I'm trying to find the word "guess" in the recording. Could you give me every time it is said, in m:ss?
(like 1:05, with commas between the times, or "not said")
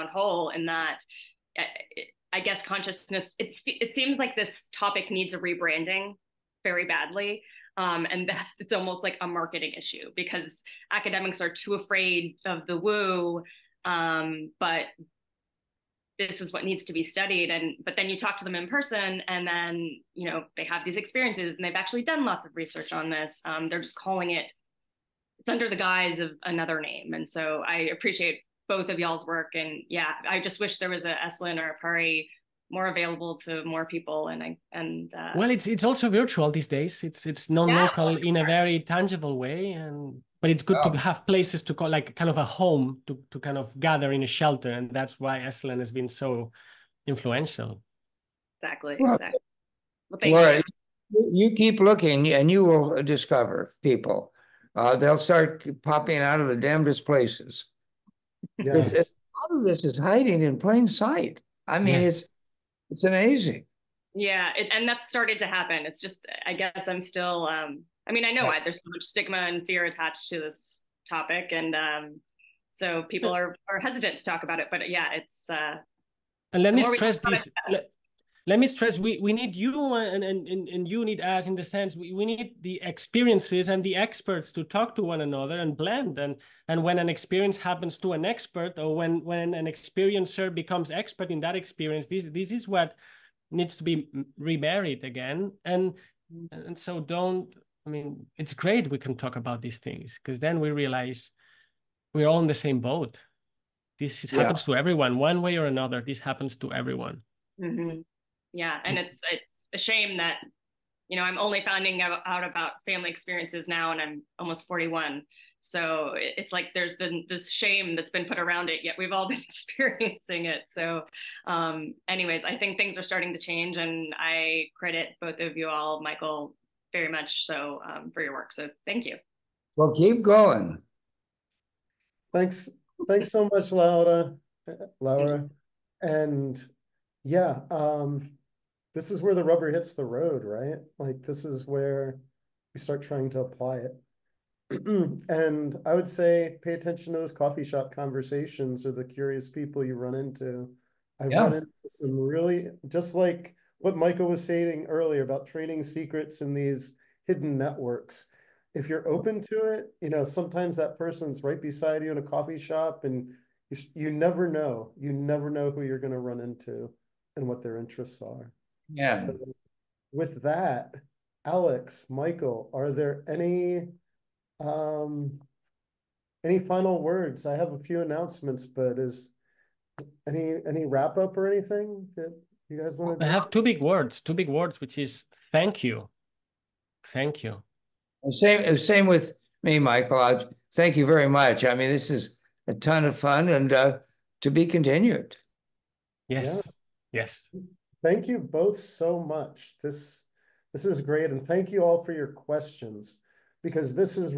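0:02, 1:06.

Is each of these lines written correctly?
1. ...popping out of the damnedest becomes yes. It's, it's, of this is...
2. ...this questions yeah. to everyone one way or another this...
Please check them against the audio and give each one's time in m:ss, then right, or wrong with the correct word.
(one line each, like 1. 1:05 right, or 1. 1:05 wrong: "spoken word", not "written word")
1. 0:55 wrong: "places", not "becomes"
2. 1:43 wrong: "happens", not "questions".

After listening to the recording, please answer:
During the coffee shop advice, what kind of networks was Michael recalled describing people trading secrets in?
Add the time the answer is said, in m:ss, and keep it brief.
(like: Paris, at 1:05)
hidden networks, at 2:37.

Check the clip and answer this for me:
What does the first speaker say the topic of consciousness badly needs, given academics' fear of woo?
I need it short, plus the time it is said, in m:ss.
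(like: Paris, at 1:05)
rebranding, at 0:05.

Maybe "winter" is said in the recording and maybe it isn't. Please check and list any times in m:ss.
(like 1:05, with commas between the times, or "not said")
not said.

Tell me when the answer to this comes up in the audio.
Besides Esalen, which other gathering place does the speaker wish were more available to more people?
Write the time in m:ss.
0:31.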